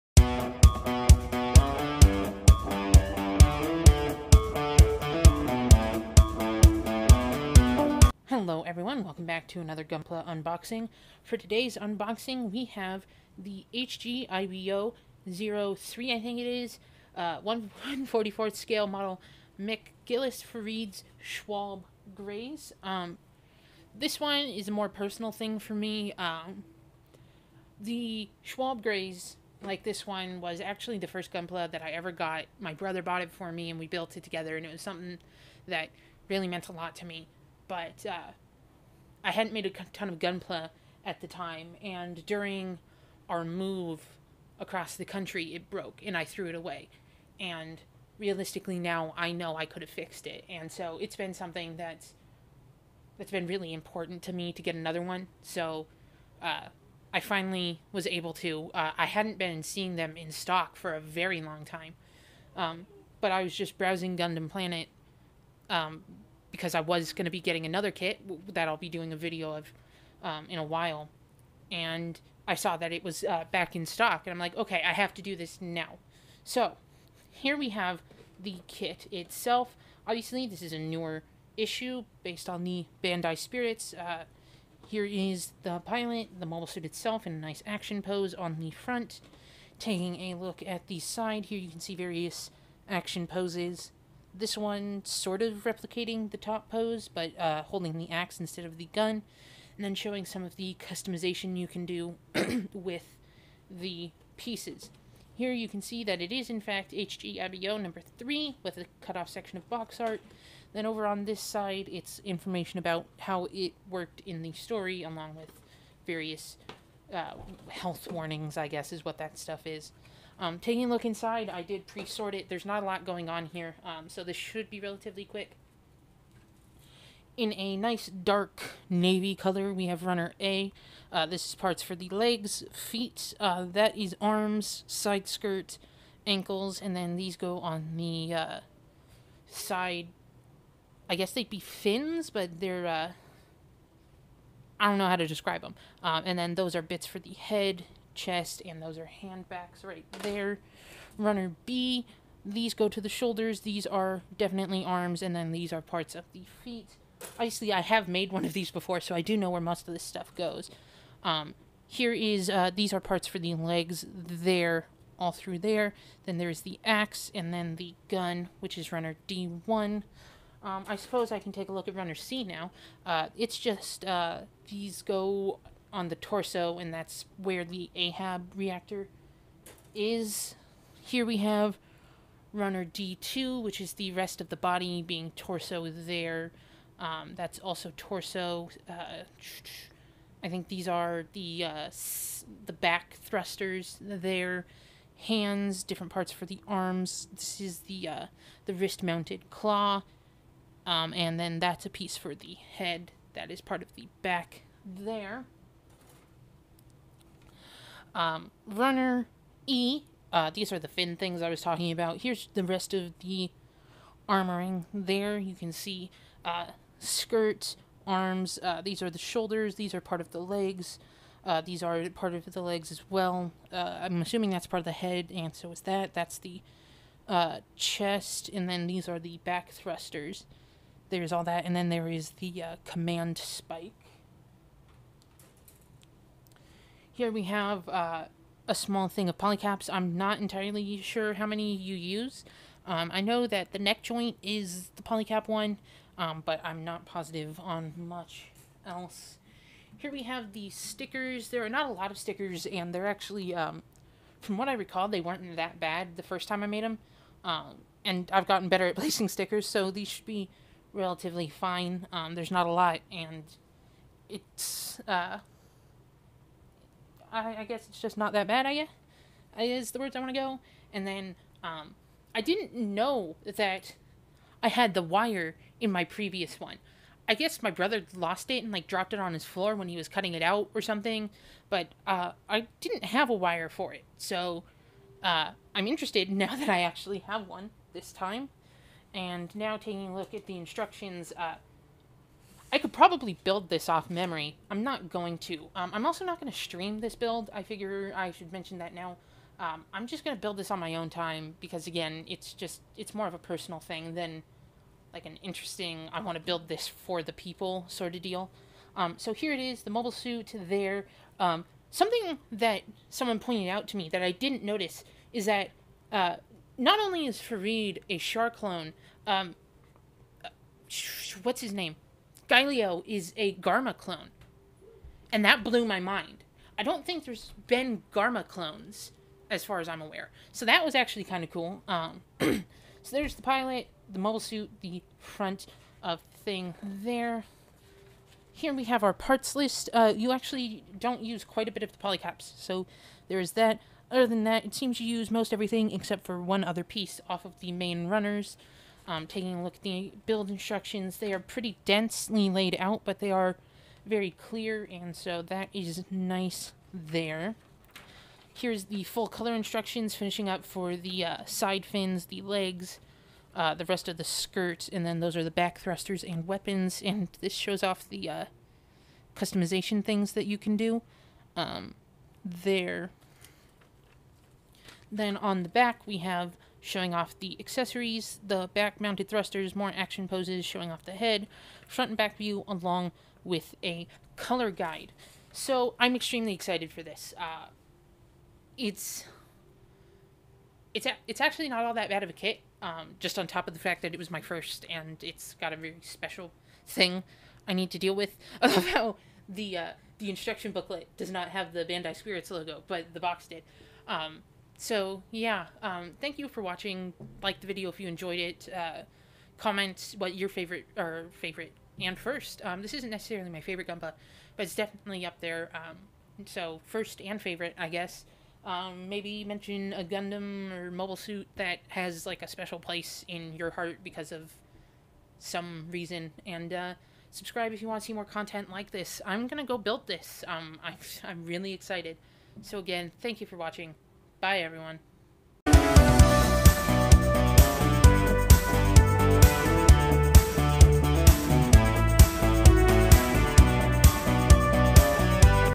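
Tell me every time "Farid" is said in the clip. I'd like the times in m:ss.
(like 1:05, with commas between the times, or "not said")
0:20, 5:17.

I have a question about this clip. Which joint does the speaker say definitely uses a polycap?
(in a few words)
Neck joint.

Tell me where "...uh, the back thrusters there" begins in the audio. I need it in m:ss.
3:11.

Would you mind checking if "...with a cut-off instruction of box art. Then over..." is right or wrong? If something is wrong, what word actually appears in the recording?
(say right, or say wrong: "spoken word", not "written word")
wrong: "section", not "instruction".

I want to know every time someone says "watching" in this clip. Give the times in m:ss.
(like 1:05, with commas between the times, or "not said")
6:46, 7:13.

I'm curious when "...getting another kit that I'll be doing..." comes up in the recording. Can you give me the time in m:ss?
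1:07.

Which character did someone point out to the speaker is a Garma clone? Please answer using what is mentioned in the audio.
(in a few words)
Galio.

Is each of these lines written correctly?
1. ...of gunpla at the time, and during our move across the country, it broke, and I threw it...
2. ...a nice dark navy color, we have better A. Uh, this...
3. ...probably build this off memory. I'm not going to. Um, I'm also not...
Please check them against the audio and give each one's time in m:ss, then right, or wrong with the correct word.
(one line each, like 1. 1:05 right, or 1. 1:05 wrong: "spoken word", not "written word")
1. 0:40 right
2. 2:07 wrong: "runner", not "better"
3. 4:52 right.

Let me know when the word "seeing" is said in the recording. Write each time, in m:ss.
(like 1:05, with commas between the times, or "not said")
0:59.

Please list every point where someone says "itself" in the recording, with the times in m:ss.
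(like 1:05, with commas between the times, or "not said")
1:19, 1:26.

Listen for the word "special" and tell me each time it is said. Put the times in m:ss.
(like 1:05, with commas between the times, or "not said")
6:36, 7:02.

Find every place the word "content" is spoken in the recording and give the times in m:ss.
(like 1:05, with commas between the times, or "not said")
7:08.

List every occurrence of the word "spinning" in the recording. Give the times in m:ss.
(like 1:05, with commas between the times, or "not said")
not said.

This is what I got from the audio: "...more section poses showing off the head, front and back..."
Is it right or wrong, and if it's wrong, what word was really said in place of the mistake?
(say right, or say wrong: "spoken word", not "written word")
wrong: "action", not "section".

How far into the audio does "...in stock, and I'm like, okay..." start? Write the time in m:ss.
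1:13.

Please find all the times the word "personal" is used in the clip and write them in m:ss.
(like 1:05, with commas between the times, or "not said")
0:24, 5:03.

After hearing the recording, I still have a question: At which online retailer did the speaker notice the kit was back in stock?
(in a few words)
Gundam Planet.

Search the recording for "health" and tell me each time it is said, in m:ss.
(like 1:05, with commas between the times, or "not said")
1:57.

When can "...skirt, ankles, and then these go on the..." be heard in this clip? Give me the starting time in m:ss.
2:15.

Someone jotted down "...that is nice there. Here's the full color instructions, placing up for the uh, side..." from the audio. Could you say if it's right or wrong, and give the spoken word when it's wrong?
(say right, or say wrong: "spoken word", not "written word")
wrong: "finishing", not "placing".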